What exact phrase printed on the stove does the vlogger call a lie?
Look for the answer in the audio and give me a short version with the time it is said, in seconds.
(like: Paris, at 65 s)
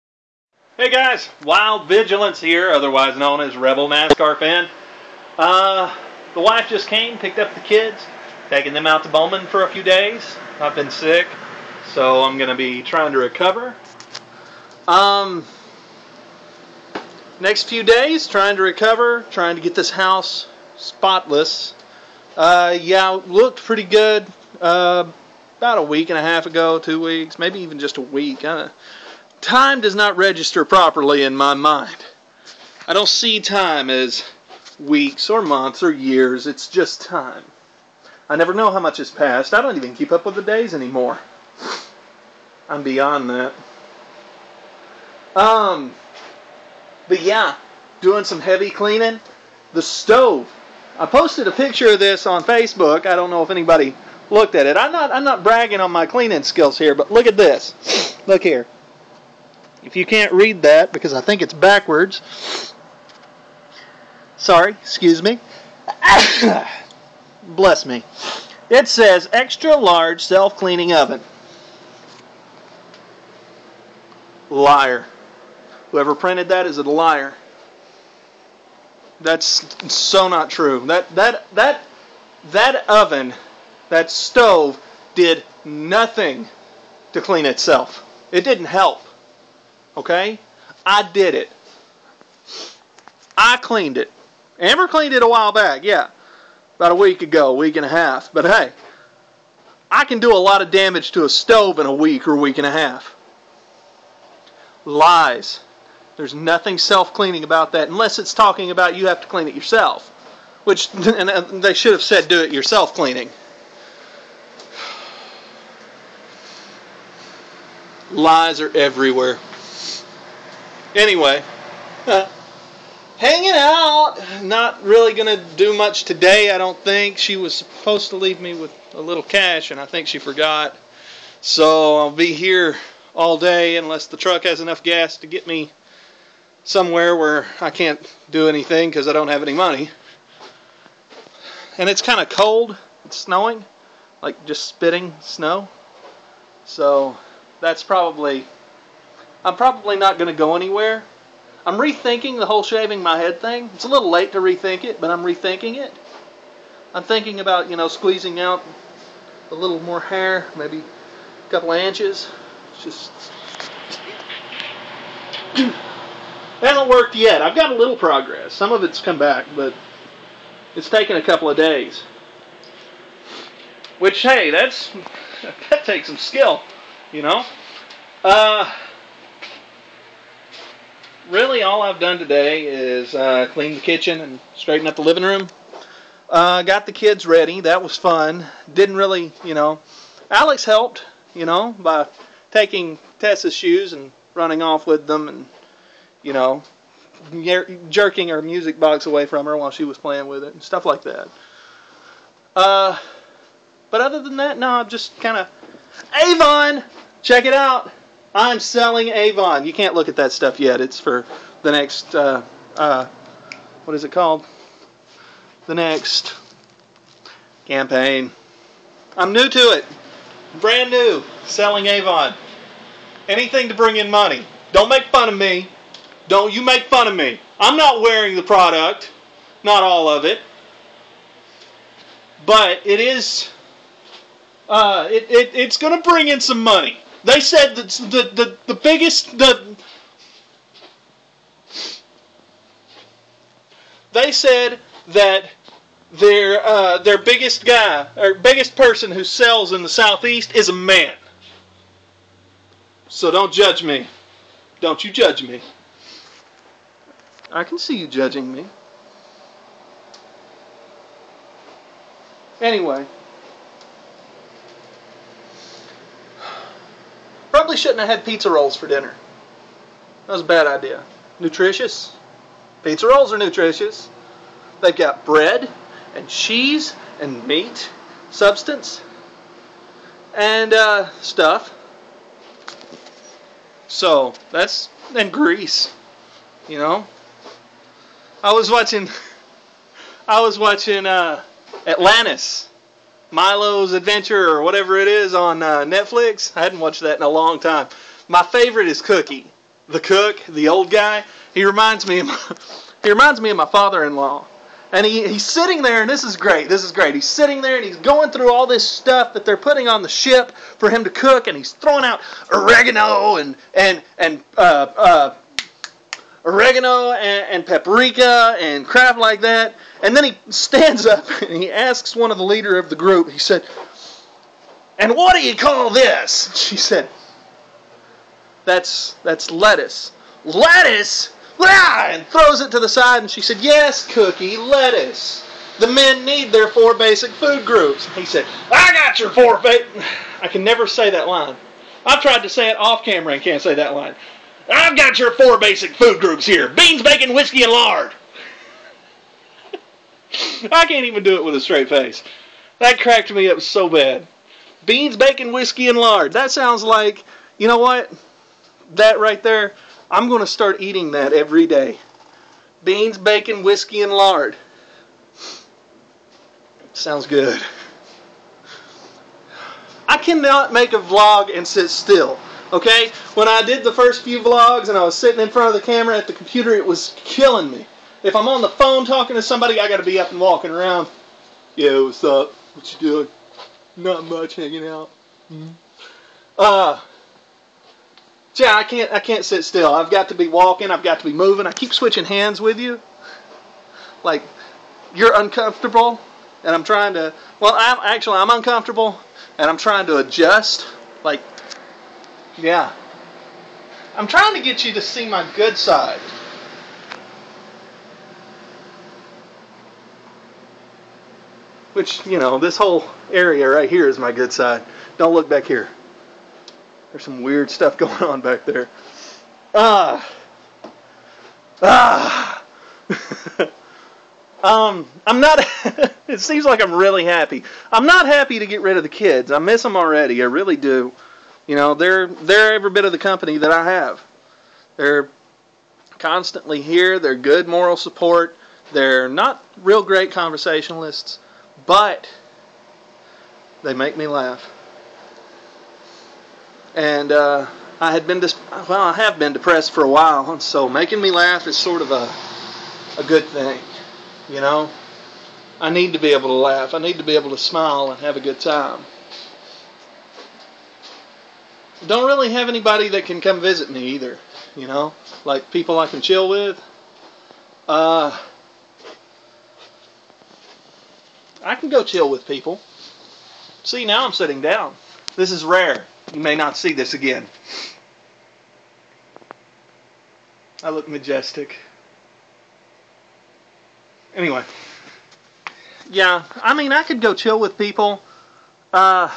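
Extra large self cleaning oven, at 69 s.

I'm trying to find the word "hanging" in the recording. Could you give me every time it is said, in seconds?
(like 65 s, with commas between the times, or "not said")
123 s, 384 s.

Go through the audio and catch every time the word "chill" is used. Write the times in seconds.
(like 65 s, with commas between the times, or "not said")
466 s, 472 s, 487 s.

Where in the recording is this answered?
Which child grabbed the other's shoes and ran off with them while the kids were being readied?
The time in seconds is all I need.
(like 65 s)
190 s.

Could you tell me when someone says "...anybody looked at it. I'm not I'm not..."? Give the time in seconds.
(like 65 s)
53 s.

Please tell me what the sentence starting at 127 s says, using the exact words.
She was supposed to leave me with a little cash, and I think she forgot.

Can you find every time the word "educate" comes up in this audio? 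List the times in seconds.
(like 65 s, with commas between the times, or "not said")
not said.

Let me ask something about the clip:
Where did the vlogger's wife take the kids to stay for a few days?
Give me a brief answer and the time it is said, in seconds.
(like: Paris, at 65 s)
Bowman, at 9 s.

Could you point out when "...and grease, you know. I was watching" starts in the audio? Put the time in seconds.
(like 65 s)
285 s.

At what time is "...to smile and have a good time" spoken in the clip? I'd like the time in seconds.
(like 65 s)
457 s.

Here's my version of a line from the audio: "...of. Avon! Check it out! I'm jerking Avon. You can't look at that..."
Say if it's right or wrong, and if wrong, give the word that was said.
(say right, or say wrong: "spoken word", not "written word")
wrong: "selling", not "jerking".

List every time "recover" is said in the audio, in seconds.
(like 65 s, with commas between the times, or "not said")
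13 s, 18 s.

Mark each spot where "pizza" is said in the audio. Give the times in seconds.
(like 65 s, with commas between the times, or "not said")
268 s, 272 s.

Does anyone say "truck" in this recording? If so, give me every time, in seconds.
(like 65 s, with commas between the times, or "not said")
134 s.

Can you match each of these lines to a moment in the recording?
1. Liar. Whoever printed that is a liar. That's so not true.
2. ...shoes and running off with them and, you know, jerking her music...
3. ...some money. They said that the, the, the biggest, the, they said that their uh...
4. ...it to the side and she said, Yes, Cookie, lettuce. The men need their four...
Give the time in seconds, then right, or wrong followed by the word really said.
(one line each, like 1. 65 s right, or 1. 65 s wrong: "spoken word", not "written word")
1. 74 s right
2. 193 s right
3. 236 s right
4. 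332 s right.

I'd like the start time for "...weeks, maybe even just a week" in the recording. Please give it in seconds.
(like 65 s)
27 s.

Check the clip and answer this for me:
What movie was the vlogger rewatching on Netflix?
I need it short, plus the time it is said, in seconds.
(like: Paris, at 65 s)
Atlantis Milo's Adventure, at 291 s.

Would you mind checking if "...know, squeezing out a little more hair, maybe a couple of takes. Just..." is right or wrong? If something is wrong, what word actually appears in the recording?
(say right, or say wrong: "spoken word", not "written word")
wrong: "inches", not "takes".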